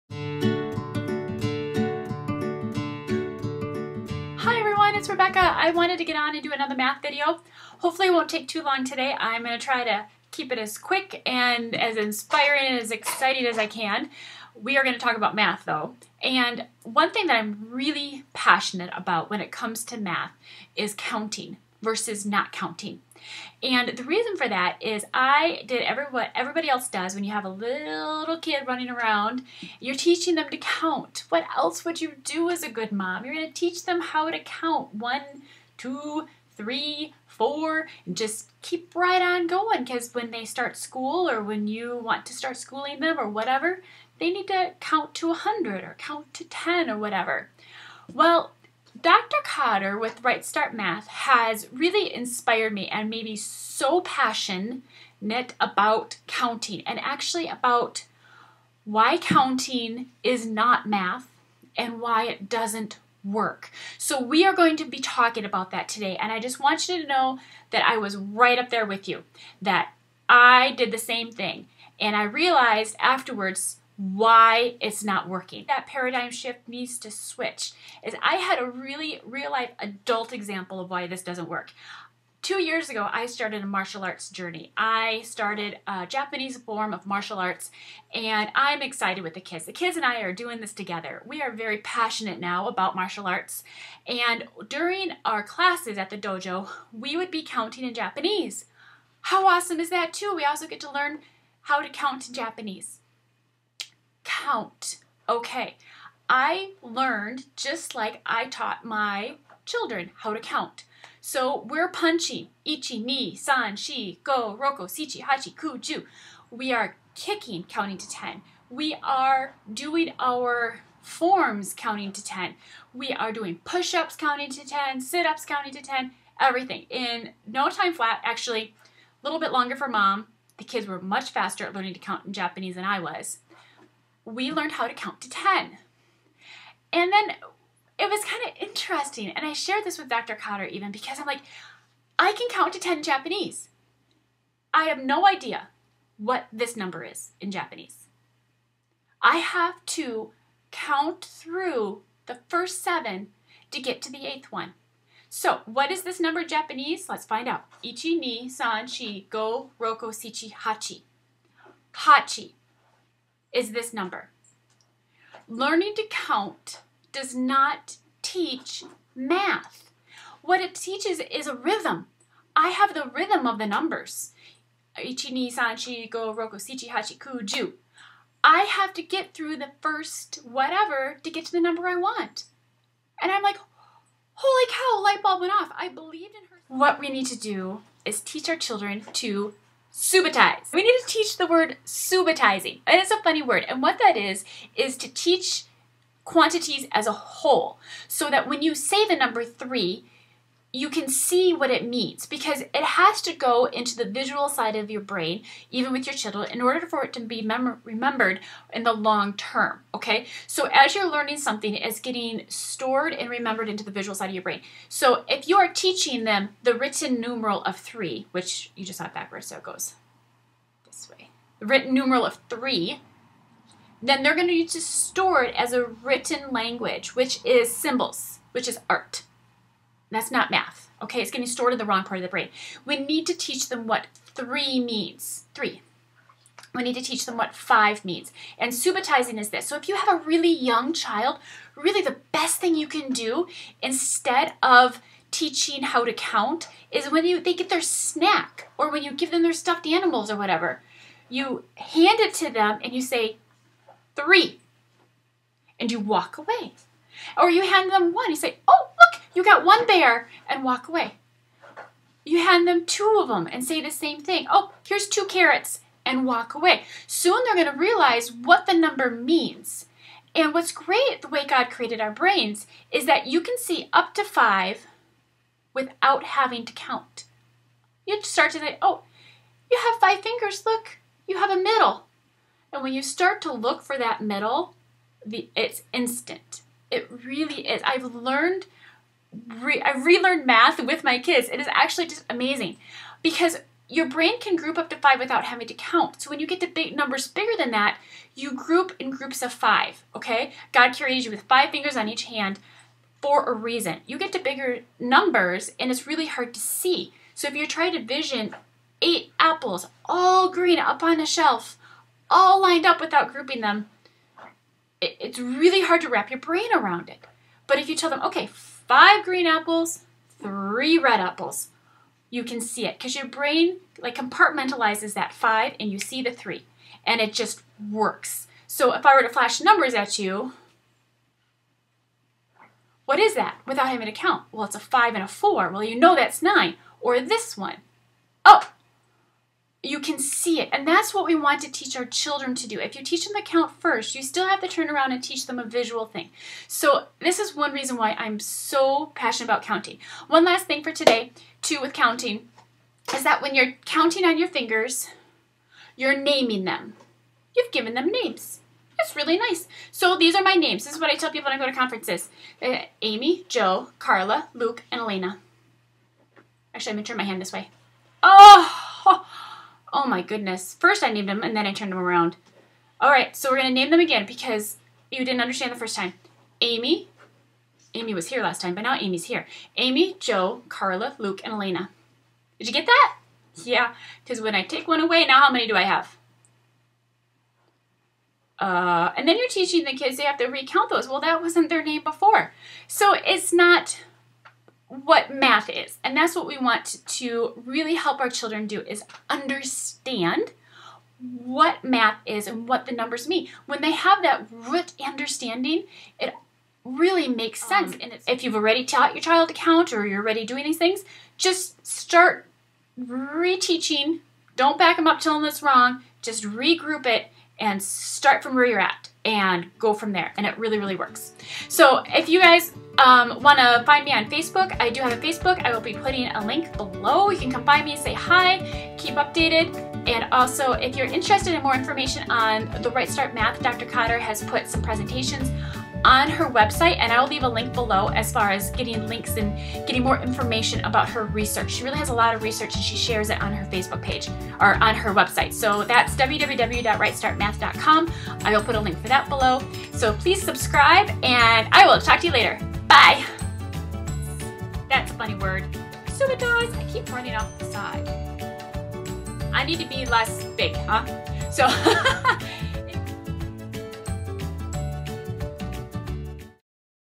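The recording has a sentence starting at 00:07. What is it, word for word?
Hopefully it won't take too long today.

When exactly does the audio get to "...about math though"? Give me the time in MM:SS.
00:15.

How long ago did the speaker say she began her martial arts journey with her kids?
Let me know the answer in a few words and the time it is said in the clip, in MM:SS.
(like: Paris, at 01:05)
2 years ago, at 01:22.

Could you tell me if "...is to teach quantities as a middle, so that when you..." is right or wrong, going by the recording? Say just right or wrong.
wrong.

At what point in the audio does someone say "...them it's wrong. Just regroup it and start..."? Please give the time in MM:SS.
06:55.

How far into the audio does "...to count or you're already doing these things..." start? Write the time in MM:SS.
06:49.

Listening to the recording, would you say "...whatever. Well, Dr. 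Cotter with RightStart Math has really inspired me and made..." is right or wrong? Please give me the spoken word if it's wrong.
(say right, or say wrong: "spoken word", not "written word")
right.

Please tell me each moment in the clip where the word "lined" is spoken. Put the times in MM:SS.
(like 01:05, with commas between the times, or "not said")
05:12.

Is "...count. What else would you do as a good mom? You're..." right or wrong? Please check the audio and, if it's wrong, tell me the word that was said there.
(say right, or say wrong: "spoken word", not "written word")
right.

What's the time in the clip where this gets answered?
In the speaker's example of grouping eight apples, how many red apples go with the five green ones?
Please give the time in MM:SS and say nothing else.
05:20.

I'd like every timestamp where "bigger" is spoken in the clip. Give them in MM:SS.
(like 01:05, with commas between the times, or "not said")
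04:57, 05:04.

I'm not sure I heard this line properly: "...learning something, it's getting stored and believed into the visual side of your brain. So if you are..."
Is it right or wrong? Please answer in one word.
wrong.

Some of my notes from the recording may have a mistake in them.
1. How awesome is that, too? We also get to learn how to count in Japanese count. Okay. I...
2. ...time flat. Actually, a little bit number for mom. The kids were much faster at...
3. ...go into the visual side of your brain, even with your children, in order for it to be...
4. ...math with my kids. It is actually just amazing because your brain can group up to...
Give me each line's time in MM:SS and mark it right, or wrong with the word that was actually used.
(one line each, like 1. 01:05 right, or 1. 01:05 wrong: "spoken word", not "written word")
1. 01:39 right
2. 02:07 wrong: "longer", not "number"
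3. 03:23 right
4. 04:50 right.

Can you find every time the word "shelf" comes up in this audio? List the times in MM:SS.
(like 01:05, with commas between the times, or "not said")
05:11.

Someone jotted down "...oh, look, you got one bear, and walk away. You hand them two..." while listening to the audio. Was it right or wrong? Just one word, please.
right.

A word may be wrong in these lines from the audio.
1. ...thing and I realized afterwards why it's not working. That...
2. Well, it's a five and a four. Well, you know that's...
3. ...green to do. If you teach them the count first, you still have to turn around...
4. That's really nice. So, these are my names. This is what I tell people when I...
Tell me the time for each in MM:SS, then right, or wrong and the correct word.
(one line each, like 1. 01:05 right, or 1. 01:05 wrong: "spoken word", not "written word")
1. 01:11 right
2. 05:34 right
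3. 05:42 wrong: "children", not "green"
4. 05:58 right.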